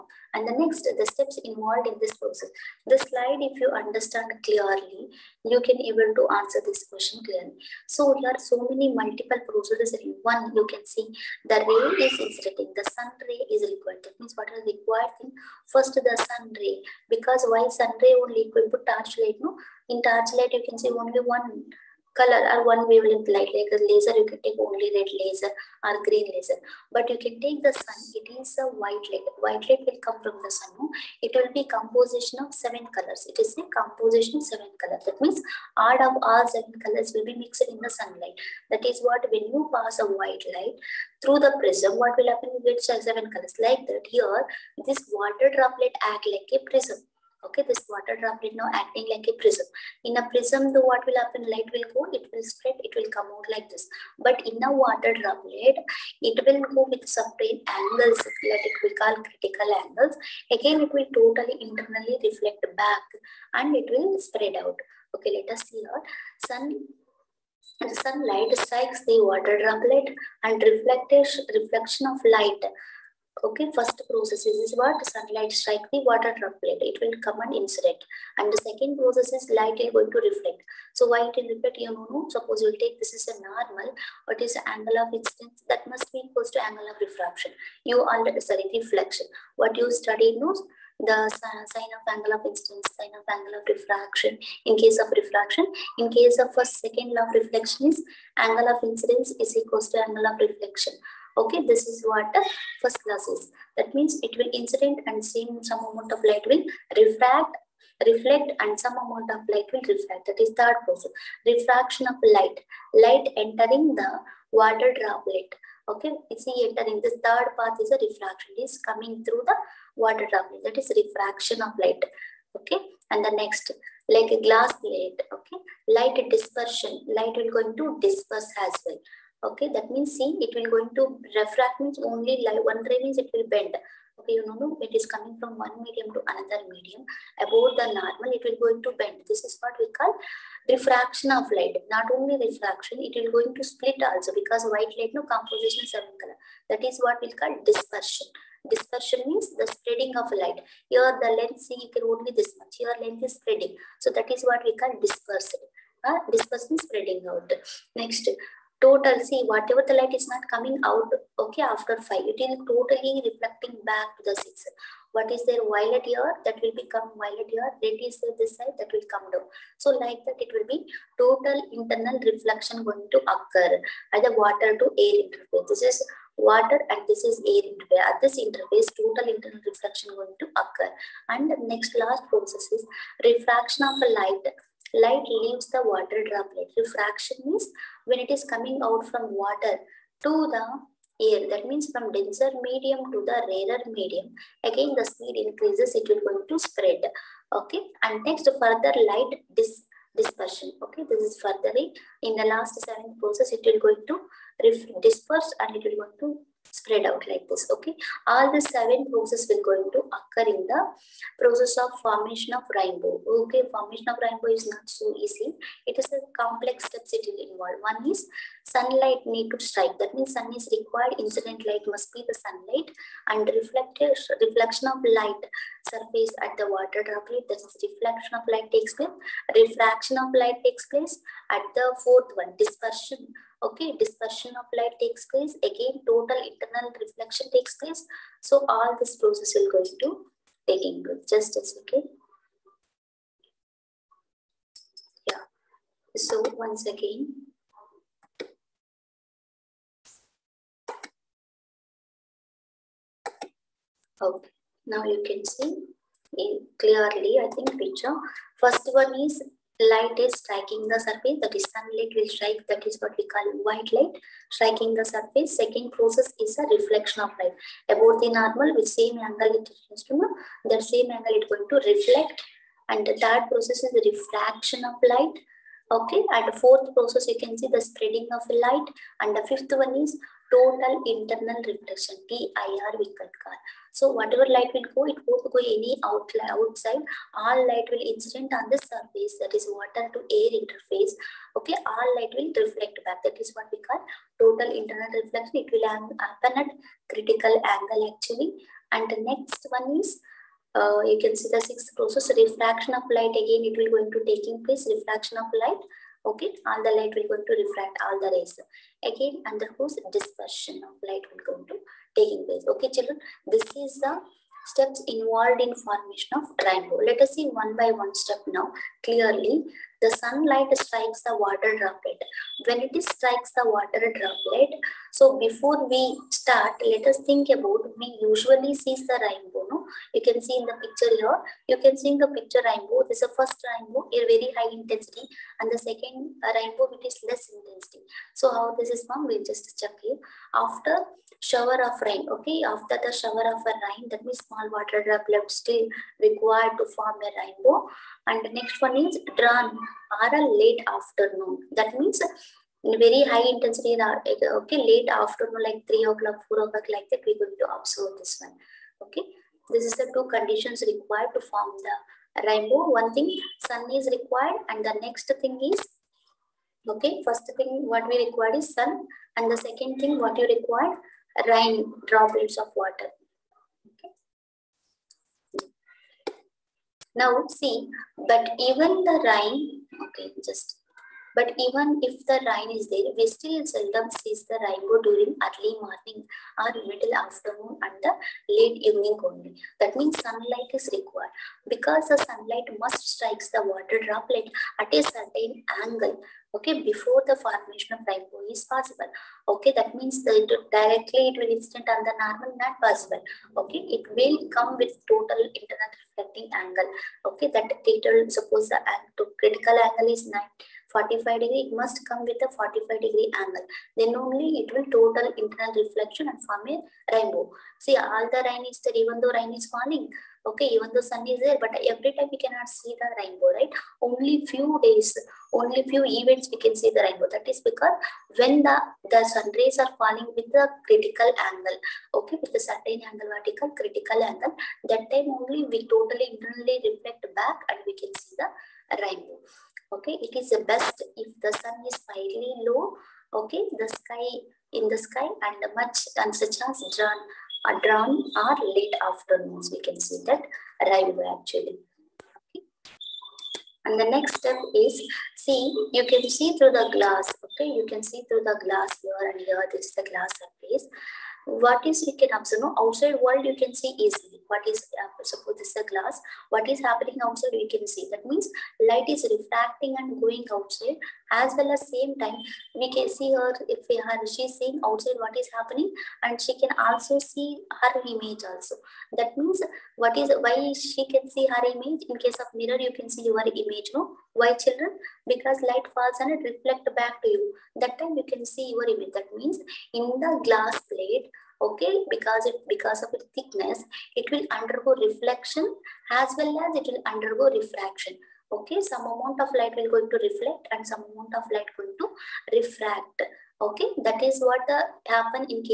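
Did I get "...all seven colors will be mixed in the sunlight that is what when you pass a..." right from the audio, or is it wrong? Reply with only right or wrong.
right.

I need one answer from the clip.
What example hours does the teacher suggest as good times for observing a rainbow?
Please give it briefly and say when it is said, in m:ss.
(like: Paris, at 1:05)
3 or 4 o'clock, at 5:55.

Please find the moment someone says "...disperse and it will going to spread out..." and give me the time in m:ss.
3:25.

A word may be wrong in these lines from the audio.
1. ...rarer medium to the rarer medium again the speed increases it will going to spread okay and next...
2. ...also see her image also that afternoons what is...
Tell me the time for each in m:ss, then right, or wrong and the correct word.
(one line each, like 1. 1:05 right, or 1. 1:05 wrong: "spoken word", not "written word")
1. 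3:12 wrong: "denser", not "rarer"
2. 7:56 wrong: "means", not "afternoons".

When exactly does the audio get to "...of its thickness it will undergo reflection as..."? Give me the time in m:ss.
8:13.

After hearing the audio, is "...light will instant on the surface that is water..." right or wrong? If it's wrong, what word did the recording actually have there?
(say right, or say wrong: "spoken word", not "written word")
wrong: "incident", not "instant".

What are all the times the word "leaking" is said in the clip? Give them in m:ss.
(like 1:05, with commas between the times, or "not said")
7:42.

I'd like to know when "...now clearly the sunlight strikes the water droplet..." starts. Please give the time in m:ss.
5:18.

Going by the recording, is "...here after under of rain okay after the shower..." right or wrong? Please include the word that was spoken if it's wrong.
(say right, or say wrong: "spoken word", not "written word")
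wrong: "shower", not "under".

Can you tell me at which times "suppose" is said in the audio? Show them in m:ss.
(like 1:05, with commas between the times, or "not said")
1:22, 6:48, 7:45.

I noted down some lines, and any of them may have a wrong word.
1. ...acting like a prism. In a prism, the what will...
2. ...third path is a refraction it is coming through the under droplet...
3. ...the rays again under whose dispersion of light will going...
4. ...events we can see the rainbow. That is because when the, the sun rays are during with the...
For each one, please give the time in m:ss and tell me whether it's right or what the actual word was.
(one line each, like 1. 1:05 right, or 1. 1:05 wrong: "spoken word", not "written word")
1. 0:48 right
2. 1:57 wrong: "water", not "under"
3. 5:08 right
4. 7:06 wrong: "falling", not "during".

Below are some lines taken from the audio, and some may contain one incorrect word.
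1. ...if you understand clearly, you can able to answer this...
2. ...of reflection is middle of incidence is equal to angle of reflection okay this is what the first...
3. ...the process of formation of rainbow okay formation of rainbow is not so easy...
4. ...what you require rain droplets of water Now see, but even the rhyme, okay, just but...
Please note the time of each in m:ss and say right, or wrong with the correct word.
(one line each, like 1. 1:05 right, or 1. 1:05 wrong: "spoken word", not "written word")
1. 0:03 right
2. 1:37 wrong: "angle", not "middle"
3. 3:30 right
4. 6:10 right.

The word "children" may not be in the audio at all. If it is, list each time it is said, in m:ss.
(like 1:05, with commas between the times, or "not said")
5:12, 8:04.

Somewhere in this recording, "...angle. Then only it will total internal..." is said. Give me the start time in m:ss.
6:53.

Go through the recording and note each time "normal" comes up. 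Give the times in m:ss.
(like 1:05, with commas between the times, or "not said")
1:23, 2:17, 4:28, 6:42.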